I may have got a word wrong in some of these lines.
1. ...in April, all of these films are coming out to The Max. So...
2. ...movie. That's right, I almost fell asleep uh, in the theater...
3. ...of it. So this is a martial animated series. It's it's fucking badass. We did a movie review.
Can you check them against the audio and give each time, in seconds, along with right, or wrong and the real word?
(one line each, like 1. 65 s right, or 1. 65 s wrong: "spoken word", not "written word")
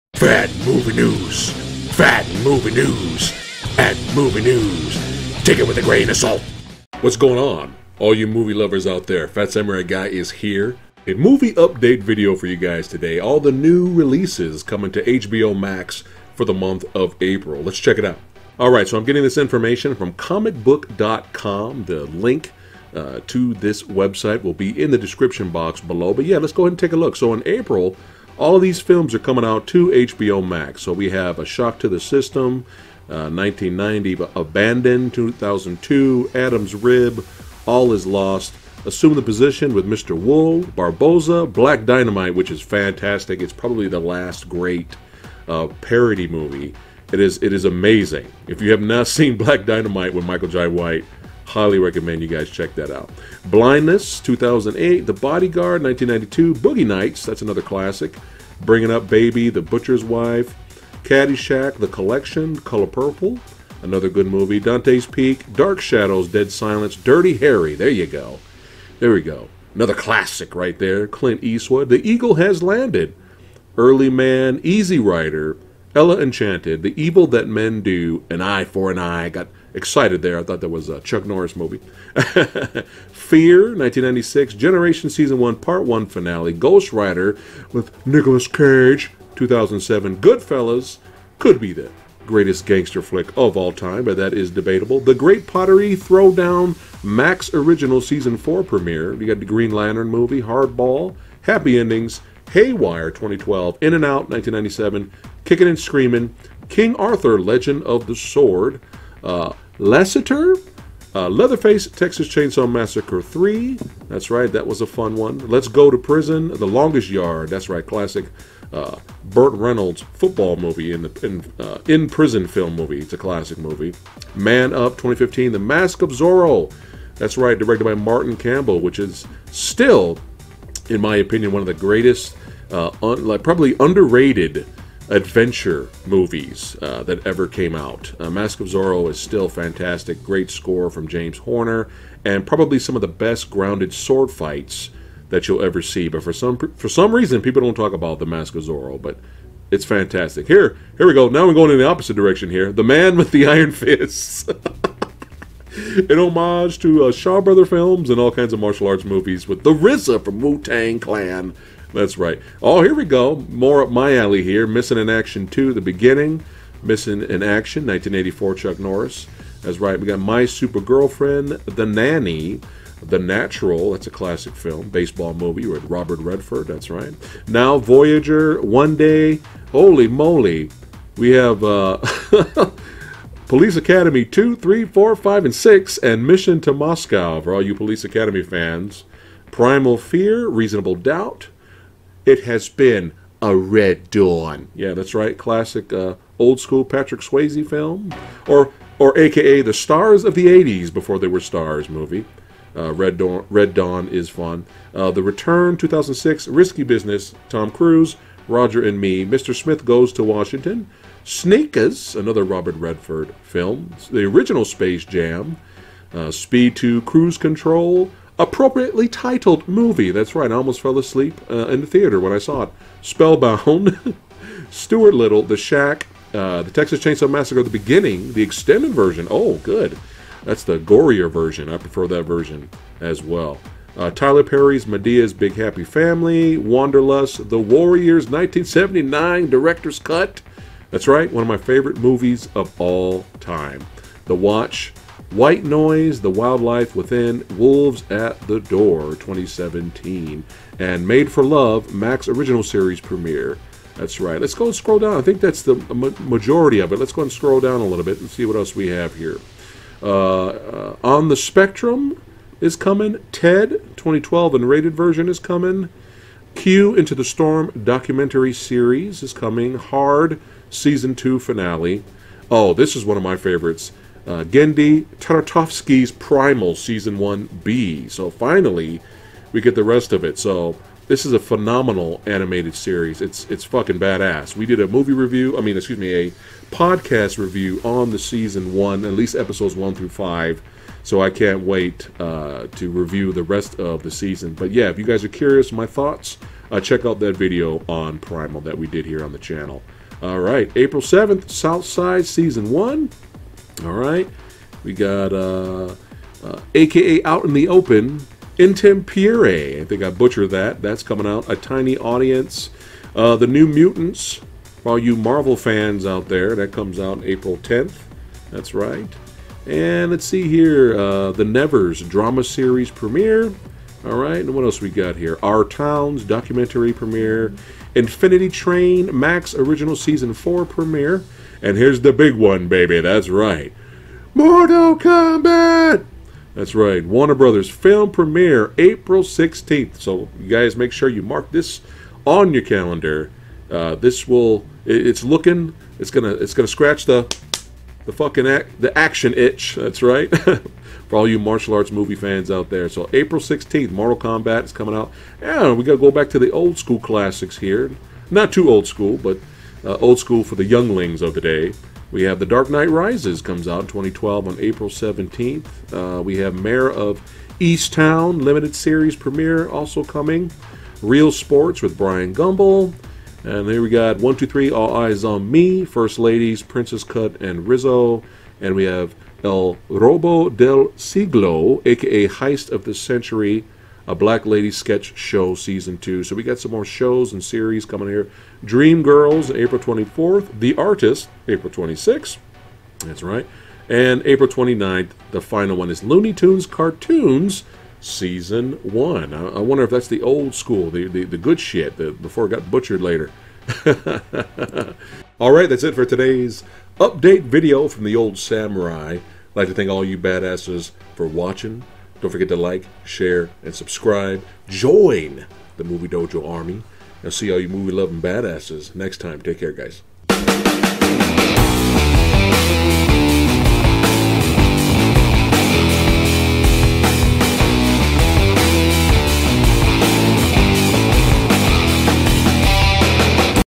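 1. 27 s wrong: "HBO", not "The"
2. 219 s right
3. 280 s wrong: "phenomenal", not "martial".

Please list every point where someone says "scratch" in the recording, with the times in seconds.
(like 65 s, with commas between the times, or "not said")
346 s.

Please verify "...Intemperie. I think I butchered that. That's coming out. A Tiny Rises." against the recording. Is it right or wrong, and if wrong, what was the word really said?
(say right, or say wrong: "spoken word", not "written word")
wrong: "Audience", not "Rises".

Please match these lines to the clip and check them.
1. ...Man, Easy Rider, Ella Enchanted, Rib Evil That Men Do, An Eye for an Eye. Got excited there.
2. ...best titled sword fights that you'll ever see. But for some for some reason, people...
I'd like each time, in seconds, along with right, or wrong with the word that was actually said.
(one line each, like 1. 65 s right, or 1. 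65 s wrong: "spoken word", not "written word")
1. 74 s wrong: "The", not "Rib"
2. 143 s wrong: "grounded", not "titled".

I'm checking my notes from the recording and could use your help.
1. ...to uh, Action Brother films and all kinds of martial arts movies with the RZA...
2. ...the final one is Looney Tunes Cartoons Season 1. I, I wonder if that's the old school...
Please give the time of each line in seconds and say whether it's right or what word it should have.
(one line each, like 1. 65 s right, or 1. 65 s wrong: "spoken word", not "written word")
1. 156 s wrong: "Shaw", not "Action"
2. 395 s right.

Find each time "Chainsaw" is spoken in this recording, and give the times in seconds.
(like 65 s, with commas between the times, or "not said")
112 s, 226 s.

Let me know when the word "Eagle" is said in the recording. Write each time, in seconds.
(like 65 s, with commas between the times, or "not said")
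72 s.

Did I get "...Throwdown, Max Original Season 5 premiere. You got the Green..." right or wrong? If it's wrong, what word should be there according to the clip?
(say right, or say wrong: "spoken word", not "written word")
wrong: "4", not "5".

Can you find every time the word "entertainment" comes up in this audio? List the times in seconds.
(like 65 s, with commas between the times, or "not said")
not said.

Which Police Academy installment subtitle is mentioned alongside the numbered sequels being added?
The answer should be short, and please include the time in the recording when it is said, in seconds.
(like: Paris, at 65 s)
Mission to Moscow, at 186 s.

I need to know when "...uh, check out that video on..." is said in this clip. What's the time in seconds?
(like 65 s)
296 s.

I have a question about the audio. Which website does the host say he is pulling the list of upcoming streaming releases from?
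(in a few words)
comicbook.com.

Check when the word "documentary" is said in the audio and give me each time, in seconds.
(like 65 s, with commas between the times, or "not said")
267 s, 326 s.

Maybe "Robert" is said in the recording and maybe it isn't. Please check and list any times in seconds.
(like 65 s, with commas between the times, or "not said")
175 s, 212 s.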